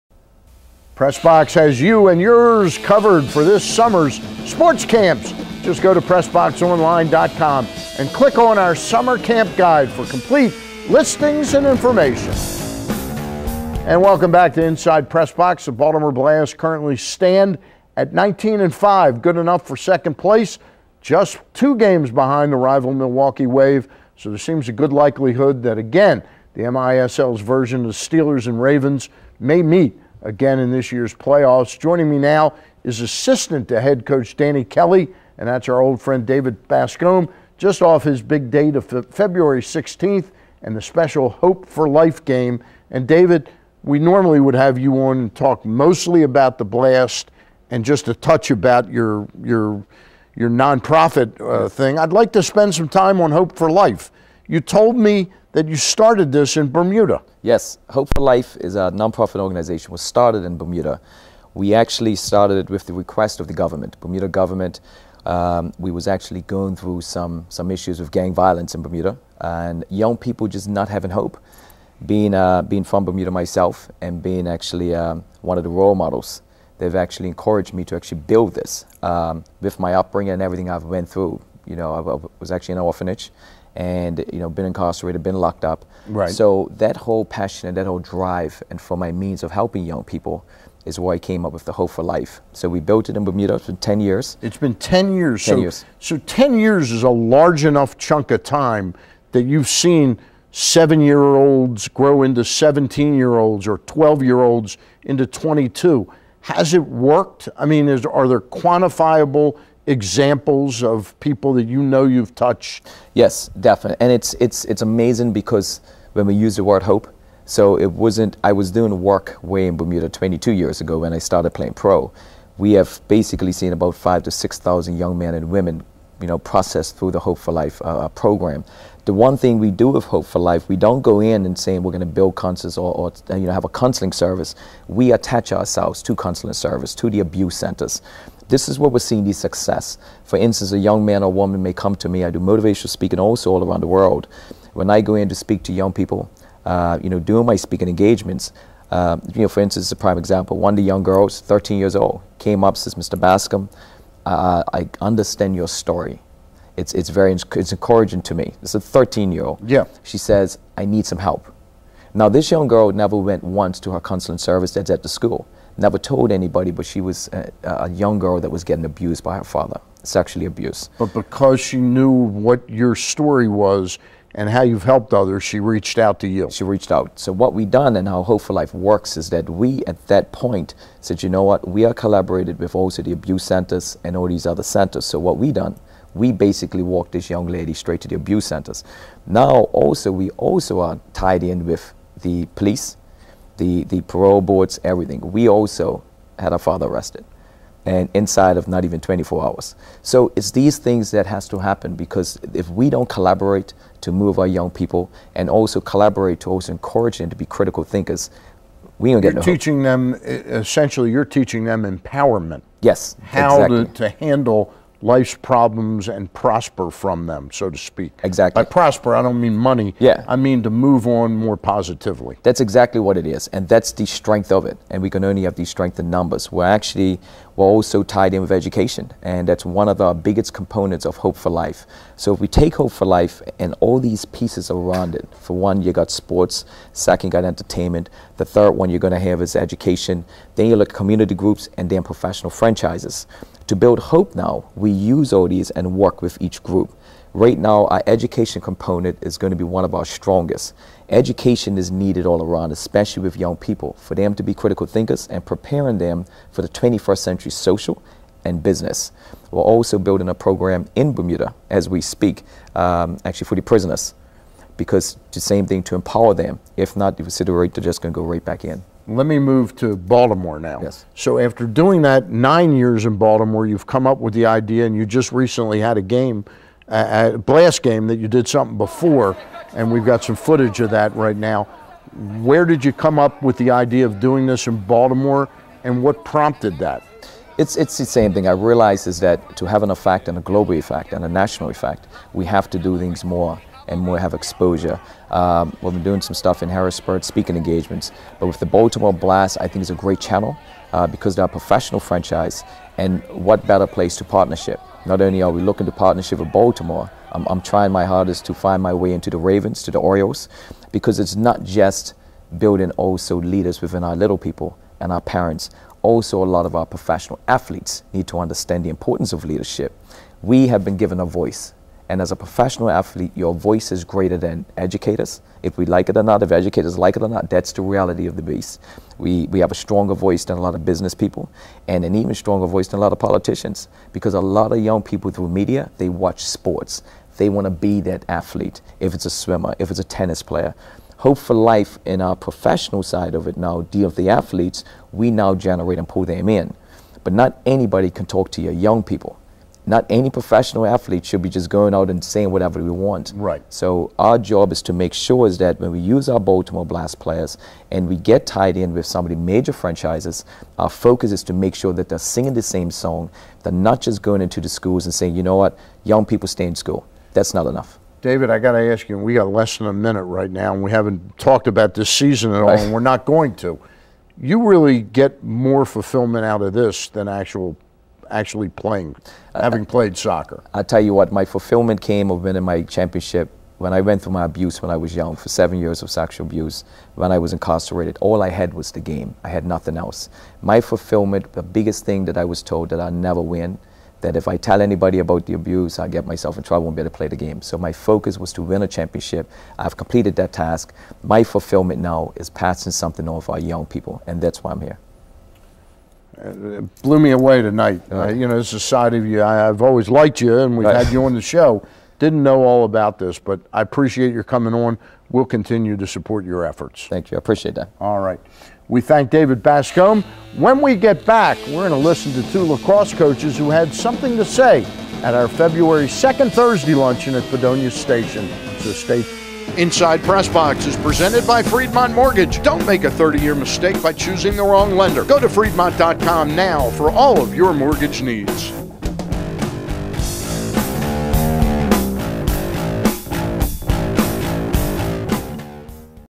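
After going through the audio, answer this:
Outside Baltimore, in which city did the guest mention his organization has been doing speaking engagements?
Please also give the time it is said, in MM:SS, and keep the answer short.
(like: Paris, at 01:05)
Harrisburg, at 04:56.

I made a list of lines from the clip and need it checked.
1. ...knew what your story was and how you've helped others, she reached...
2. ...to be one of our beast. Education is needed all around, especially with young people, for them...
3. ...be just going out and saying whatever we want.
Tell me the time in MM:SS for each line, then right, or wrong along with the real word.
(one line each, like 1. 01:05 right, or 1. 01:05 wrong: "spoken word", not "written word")
1. 02:51 right
2. 04:09 wrong: "strongest", not "beast"
3. 05:51 right.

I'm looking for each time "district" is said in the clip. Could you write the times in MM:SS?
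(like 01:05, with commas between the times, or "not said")
not said.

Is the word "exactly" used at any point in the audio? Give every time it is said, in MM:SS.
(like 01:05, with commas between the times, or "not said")
03:33, 03:38, 03:42.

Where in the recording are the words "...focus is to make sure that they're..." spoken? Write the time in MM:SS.
06:00.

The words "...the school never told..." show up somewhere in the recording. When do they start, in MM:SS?
02:45.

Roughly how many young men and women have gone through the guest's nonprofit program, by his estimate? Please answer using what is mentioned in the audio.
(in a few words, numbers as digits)
5,000 to 6,000.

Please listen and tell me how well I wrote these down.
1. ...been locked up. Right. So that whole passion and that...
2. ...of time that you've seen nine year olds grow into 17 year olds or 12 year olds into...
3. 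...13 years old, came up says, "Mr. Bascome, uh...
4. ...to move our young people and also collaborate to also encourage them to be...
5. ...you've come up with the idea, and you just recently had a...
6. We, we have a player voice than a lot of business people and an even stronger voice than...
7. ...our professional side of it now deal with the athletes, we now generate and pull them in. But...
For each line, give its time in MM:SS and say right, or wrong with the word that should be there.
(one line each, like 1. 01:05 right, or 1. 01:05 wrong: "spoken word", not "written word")
1. 01:25 right
2. 01:38 wrong: "seven", not "nine"
3. 02:31 right
4. 03:24 right
5. 04:33 right
6. 05:29 wrong: "stronger", not "player"
7. 05:42 right.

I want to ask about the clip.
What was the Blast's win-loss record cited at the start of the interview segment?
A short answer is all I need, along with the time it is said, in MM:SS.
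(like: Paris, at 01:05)
19 and 5, at 00:18.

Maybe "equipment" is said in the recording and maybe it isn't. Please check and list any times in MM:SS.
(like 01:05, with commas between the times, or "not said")
not said.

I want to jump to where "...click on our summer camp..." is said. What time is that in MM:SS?
00:08.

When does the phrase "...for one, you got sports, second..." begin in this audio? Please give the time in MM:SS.
03:55.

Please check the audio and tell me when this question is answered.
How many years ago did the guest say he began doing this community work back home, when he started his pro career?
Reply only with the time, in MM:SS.
02:00.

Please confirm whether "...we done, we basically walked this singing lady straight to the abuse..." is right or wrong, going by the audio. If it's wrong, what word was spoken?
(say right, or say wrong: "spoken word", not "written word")
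wrong: "young", not "singing".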